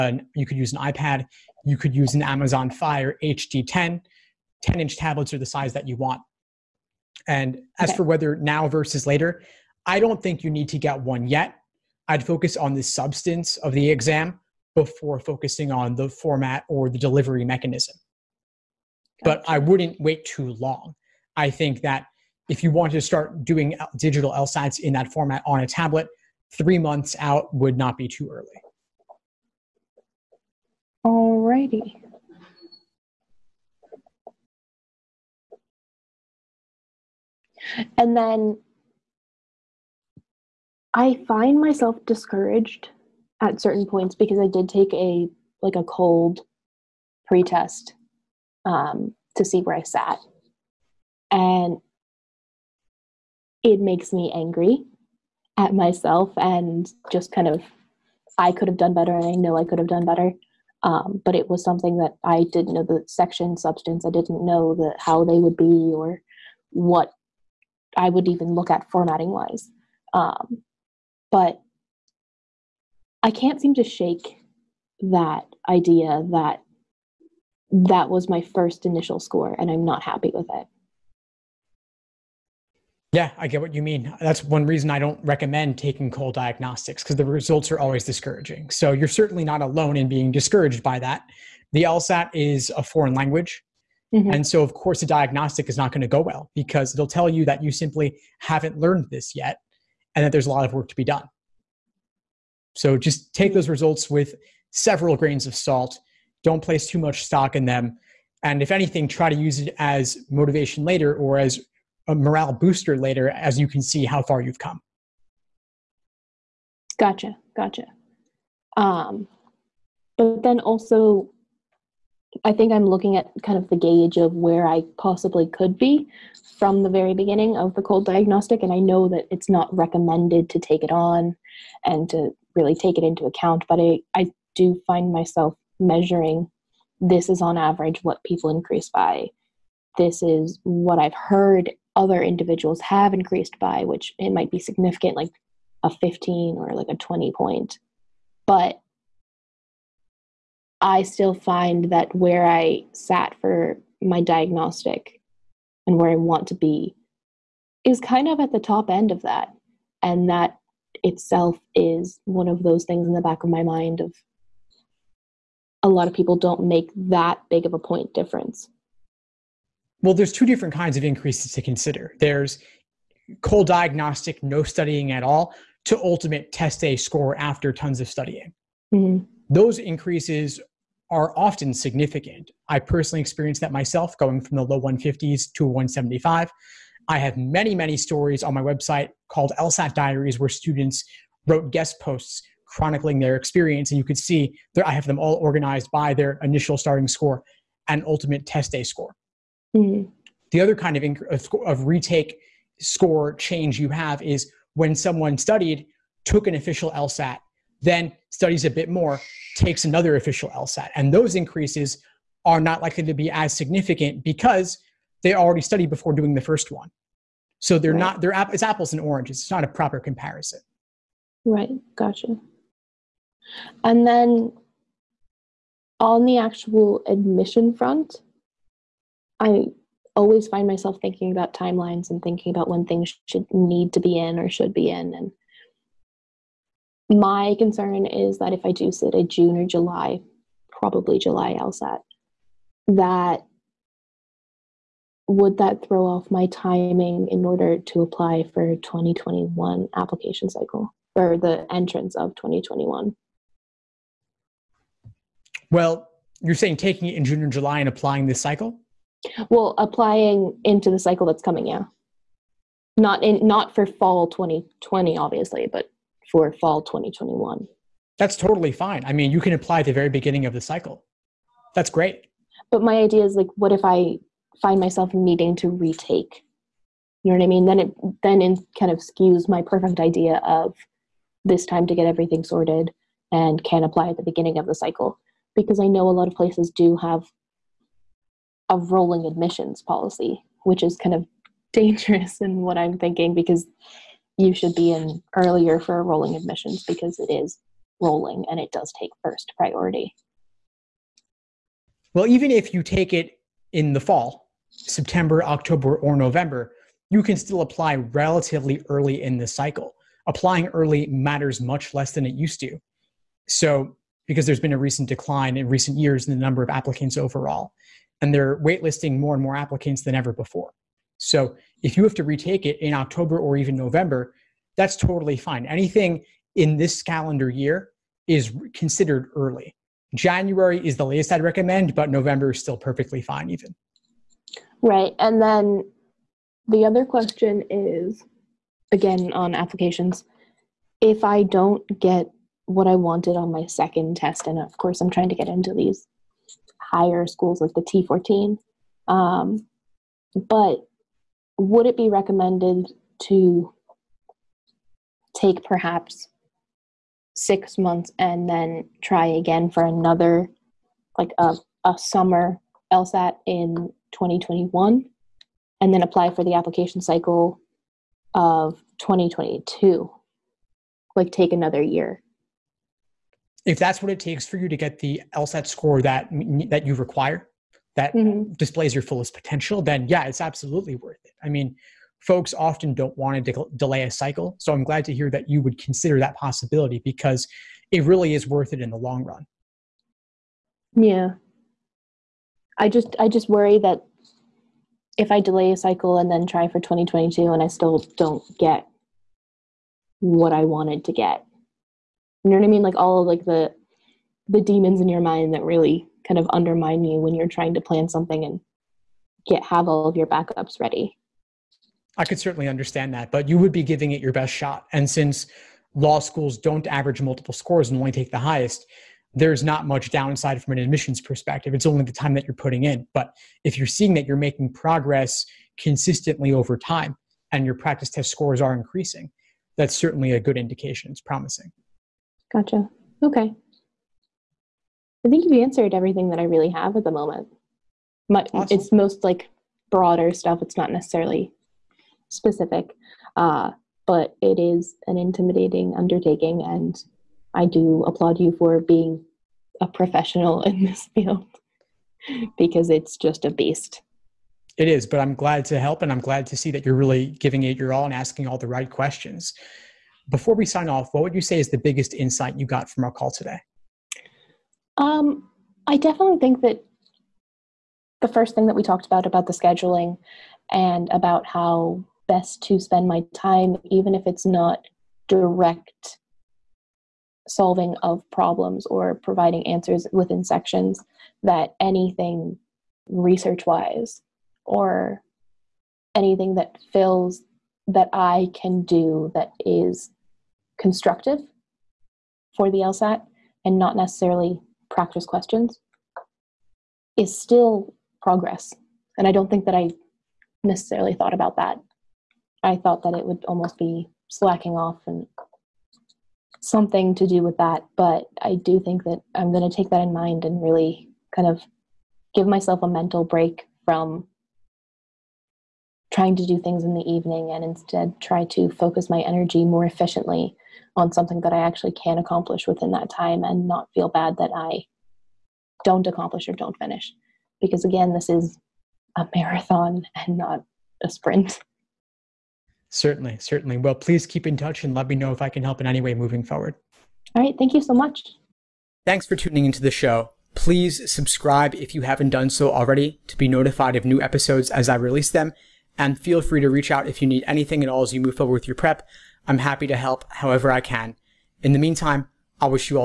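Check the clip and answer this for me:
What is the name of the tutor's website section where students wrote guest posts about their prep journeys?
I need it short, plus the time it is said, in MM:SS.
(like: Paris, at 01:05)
LSAT Diaries, at 03:09.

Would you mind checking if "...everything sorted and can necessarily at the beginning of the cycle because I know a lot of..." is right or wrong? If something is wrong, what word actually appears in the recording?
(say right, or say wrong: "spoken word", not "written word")
wrong: "apply", not "necessarily".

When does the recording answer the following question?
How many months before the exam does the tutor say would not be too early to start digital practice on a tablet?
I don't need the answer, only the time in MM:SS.
00:26.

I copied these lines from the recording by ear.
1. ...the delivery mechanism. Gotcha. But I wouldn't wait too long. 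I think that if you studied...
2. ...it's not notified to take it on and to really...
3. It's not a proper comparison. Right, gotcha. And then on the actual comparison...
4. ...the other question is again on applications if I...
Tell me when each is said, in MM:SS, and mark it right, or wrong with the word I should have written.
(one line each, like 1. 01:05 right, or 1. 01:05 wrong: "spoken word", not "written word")
1. 00:16 wrong: "wanted", not "studied"
2. 02:09 wrong: "recommended", not "notified"
3. 03:39 wrong: "admission", not "comparison"
4. 05:36 right.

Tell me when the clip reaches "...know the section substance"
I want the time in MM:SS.
01:02.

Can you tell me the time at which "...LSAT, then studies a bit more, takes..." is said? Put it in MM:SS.
03:26.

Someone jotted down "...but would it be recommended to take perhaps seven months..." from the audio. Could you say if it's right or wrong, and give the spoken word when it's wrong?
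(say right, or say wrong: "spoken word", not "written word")
wrong: "six", not "seven".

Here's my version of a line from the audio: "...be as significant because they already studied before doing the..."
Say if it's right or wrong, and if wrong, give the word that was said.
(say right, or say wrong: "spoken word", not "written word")
right.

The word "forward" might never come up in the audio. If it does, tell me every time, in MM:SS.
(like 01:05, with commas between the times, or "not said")
08:56, 09:08.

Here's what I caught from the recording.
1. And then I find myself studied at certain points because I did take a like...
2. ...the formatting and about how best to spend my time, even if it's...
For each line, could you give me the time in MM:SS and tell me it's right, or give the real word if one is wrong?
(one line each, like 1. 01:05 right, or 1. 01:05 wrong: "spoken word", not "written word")
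1. 00:37 wrong: "discouraged", not "studied"
2. 07:49 wrong: "scheduling", not "formatting".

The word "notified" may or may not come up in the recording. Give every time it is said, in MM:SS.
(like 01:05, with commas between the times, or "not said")
09:03.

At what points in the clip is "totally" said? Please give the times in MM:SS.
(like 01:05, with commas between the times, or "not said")
04:28, 05:24.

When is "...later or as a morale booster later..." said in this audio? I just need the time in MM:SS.
01:50.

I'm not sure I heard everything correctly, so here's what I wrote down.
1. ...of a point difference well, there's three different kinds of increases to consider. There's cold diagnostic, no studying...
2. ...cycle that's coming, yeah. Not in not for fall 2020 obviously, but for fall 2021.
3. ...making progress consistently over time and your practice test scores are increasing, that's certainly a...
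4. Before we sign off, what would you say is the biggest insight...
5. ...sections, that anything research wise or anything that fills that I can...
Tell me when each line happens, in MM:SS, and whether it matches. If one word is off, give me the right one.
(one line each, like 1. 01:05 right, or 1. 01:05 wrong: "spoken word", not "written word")
1. 02:47 wrong: "two", not "three"
2. 04:20 right
3. 07:04 right
4. 07:40 right
5. 08:00 right.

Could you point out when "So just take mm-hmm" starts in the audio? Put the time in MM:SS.
01:42.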